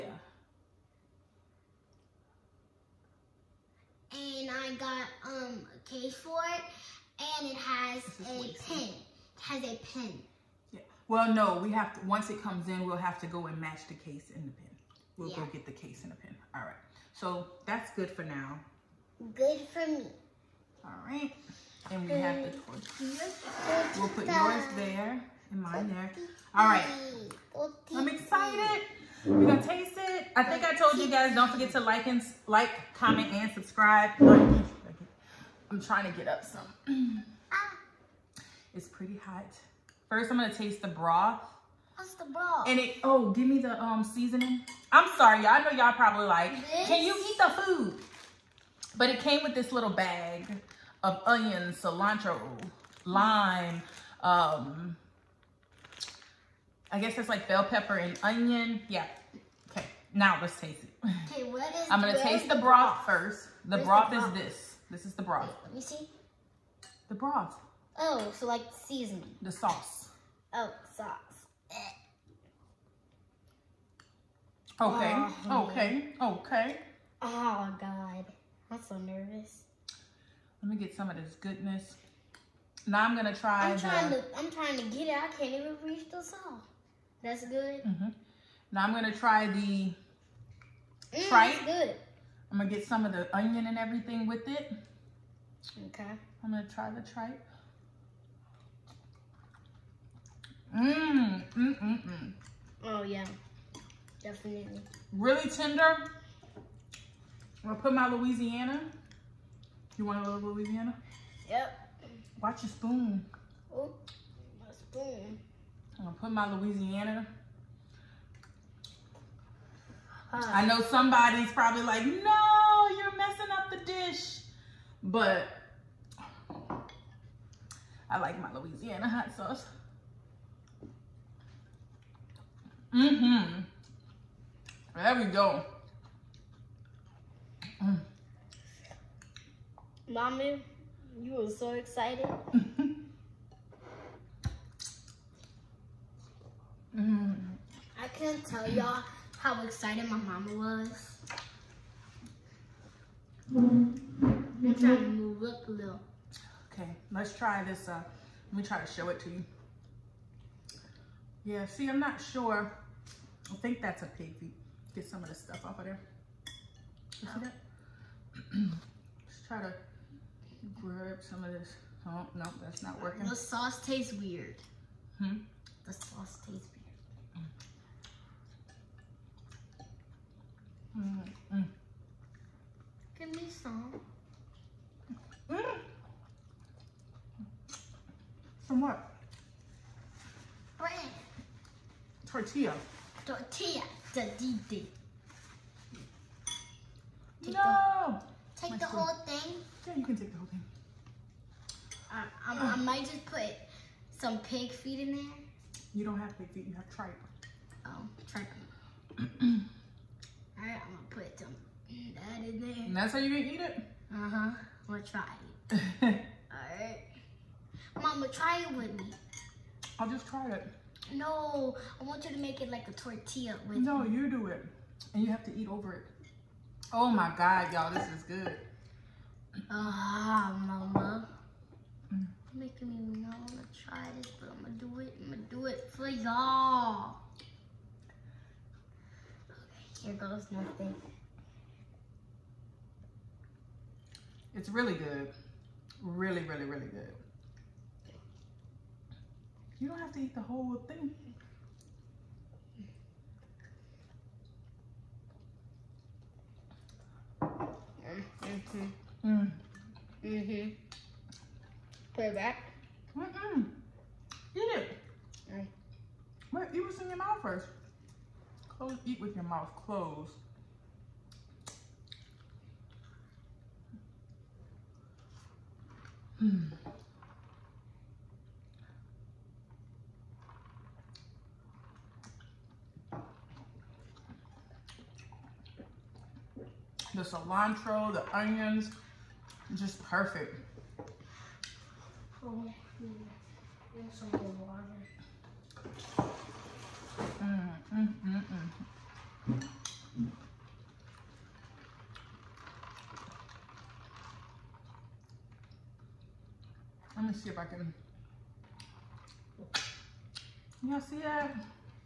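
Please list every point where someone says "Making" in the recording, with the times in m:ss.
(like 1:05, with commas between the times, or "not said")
3:52.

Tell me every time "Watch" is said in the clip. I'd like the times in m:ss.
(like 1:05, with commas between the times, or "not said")
1:52.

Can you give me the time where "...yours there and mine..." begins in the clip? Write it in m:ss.
0:24.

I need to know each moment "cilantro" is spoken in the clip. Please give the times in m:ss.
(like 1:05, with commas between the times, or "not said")
0:51, 4:47.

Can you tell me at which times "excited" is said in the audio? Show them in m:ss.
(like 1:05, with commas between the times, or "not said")
0:28, 2:21, 2:29.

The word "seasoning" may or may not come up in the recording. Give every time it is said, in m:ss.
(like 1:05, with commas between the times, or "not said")
0:44, 1:08.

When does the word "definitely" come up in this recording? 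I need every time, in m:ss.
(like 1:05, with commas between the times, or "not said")
1:44.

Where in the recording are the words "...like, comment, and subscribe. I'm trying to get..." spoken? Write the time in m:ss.
0:32.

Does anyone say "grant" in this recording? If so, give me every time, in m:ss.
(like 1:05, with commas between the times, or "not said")
not said.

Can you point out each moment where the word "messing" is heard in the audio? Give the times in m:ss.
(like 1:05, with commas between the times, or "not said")
2:03.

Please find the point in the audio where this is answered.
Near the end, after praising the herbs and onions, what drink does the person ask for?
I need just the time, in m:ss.
4:54.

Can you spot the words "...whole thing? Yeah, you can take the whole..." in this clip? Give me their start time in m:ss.
3:18.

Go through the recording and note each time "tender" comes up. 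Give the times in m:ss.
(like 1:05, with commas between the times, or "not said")
1:45.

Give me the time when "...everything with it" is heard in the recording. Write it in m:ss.
1:33.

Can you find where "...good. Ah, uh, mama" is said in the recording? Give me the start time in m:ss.
3:48.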